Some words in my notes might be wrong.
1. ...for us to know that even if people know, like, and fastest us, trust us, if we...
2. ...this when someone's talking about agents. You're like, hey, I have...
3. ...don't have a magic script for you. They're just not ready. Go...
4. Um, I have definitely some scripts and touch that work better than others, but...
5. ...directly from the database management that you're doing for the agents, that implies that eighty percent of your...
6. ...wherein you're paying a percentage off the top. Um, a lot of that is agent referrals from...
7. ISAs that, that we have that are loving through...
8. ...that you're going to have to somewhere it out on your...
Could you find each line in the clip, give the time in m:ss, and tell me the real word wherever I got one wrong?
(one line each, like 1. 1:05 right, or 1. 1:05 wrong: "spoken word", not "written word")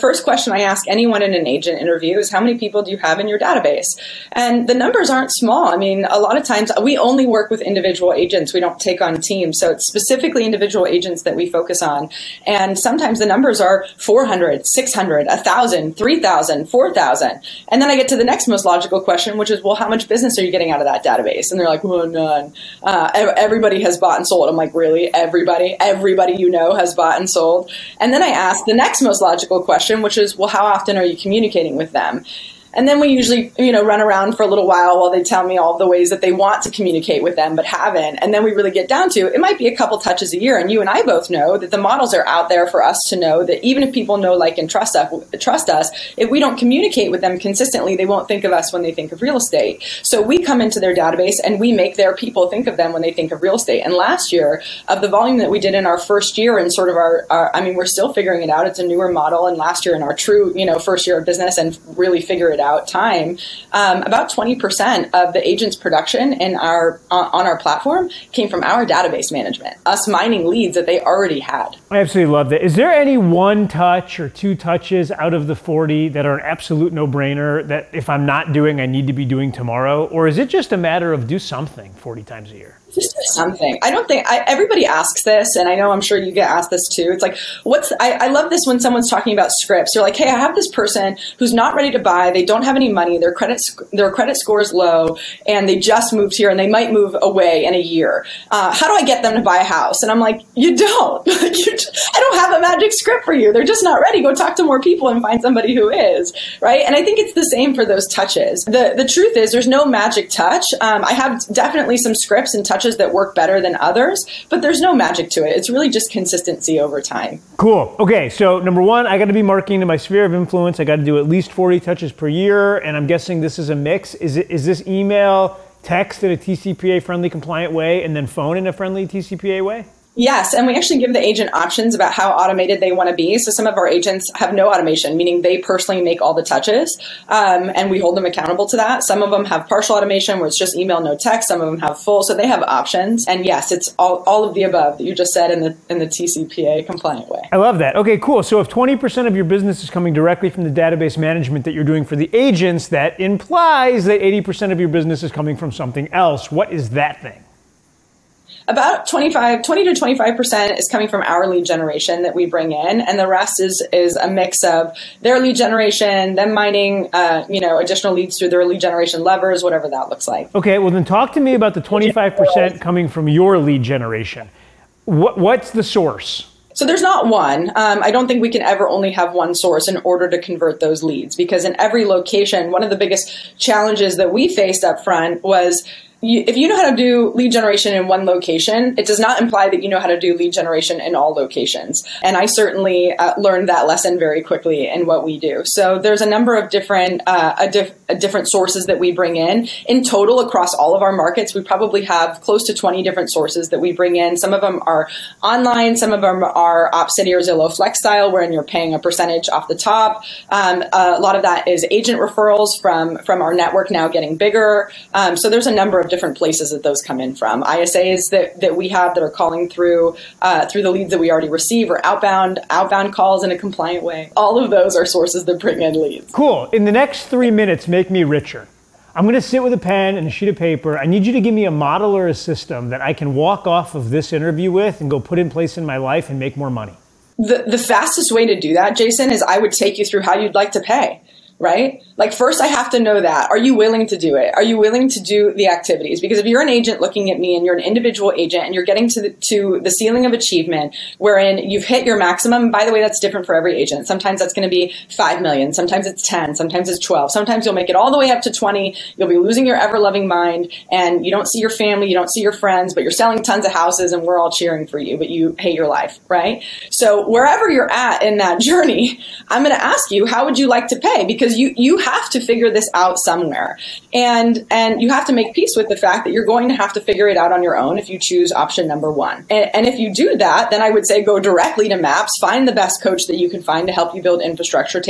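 1. 0:42 wrong: "trust", not "fastest"
2. 1:28 wrong: "scripts", not "agents"
3. 1:42 right
4. 1:50 right
5. 2:30 right
6. 3:28 right
7. 3:37 wrong: "calling", not "loving"
8. 4:36 wrong: "figure", not "somewhere".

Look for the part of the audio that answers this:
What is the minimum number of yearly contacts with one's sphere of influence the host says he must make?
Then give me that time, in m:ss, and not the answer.
2:01.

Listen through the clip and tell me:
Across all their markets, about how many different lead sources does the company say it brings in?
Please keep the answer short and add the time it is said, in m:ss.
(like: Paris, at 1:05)
20, at 3:22.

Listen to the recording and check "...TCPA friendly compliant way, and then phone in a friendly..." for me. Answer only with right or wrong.
right.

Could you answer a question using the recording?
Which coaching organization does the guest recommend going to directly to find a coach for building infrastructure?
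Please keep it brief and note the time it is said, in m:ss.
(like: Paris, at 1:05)
MAPS, at 4:41.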